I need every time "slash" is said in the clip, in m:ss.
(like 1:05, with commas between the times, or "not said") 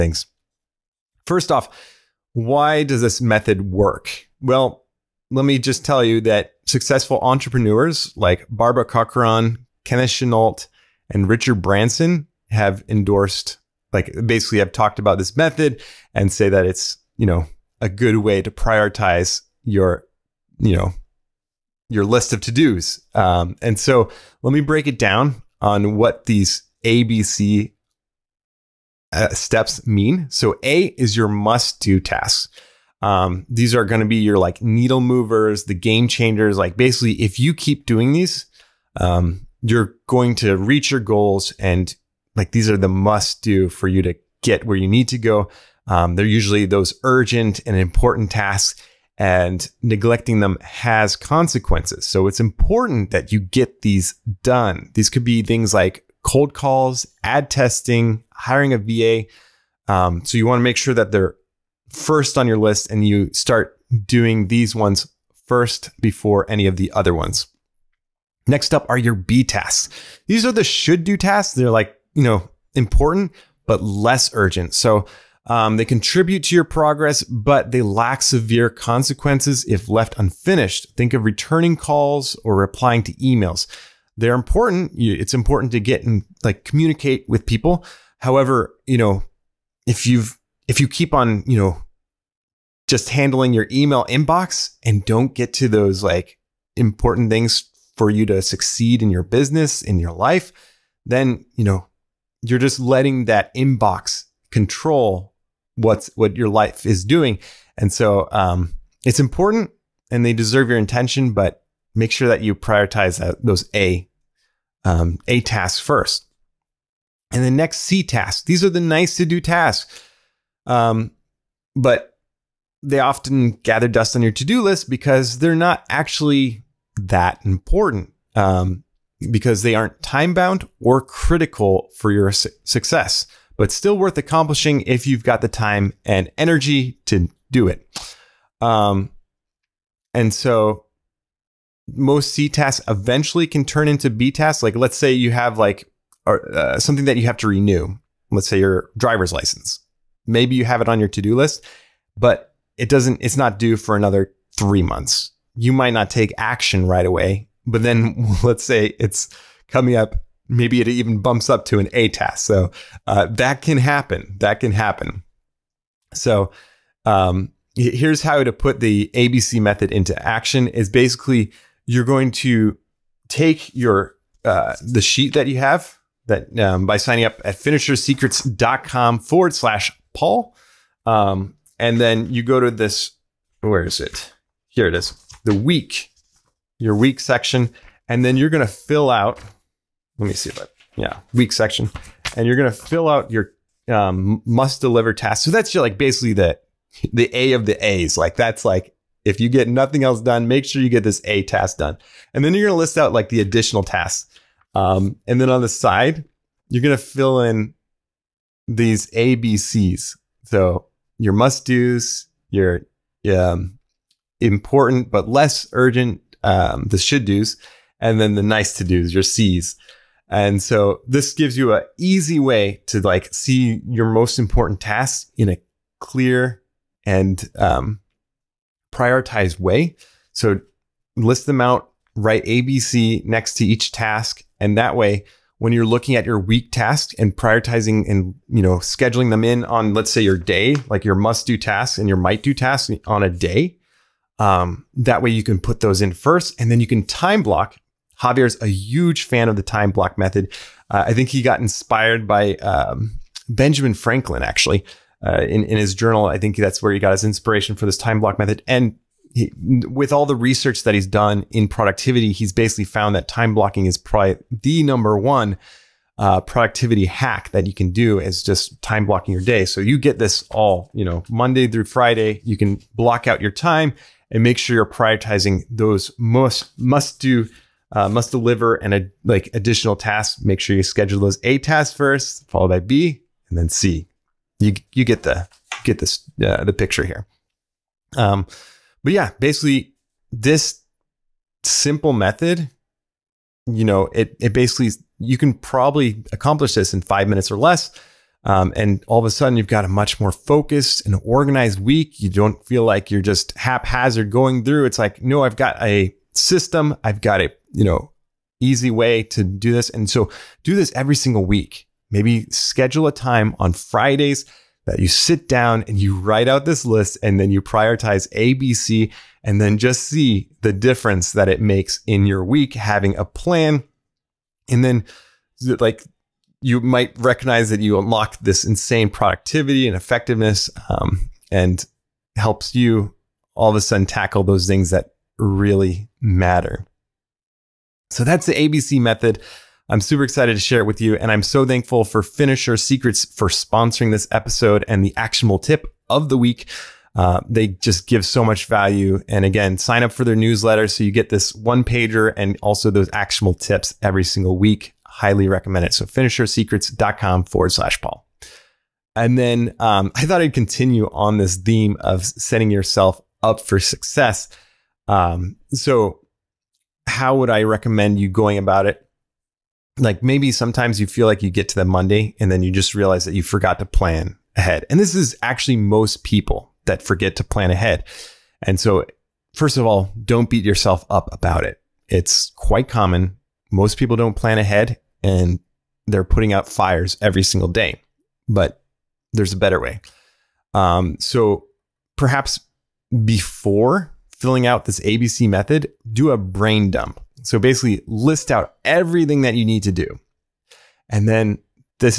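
2:59, 5:57.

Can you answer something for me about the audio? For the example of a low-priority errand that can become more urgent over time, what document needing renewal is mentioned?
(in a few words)
driver's license.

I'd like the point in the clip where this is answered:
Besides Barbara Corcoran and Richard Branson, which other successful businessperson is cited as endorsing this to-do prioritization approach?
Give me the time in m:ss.
0:09.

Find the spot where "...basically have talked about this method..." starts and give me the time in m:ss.
0:14.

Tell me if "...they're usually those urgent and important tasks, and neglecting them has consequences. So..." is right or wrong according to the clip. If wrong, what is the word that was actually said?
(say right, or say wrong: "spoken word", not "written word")
right.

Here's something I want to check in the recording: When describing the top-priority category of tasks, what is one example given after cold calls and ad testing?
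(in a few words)
hiring a VA.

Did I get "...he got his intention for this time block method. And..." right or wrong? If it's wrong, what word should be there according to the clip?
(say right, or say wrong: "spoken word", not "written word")
wrong: "inspiration", not "intention".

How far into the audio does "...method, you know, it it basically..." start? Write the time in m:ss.
4:52.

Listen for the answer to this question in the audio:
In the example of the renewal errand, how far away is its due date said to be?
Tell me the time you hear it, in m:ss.
2:34.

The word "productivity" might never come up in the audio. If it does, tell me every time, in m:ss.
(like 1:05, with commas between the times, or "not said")
4:21, 4:26, 5:29.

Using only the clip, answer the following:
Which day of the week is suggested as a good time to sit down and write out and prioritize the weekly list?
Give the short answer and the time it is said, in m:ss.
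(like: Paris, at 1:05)
Friday, at 5:13.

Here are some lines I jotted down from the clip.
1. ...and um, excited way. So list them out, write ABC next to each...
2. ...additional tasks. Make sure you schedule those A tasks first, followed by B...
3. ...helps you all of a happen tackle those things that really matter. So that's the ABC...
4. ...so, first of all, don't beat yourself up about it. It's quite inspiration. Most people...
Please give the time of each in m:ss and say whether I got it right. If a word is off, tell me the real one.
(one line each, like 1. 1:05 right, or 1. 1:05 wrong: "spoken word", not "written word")
1. 3:47 wrong: "prioritized", not "excited"
2. 4:39 right
3. 5:32 wrong: "sudden", not "happen"
4. 6:18 wrong: "common", not "inspiration".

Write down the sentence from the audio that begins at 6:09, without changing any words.
Like maybe sometimes you feel like you get to the Monday and then you just realize that you forgot to plan ahead.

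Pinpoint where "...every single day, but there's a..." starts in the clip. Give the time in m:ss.
6:27.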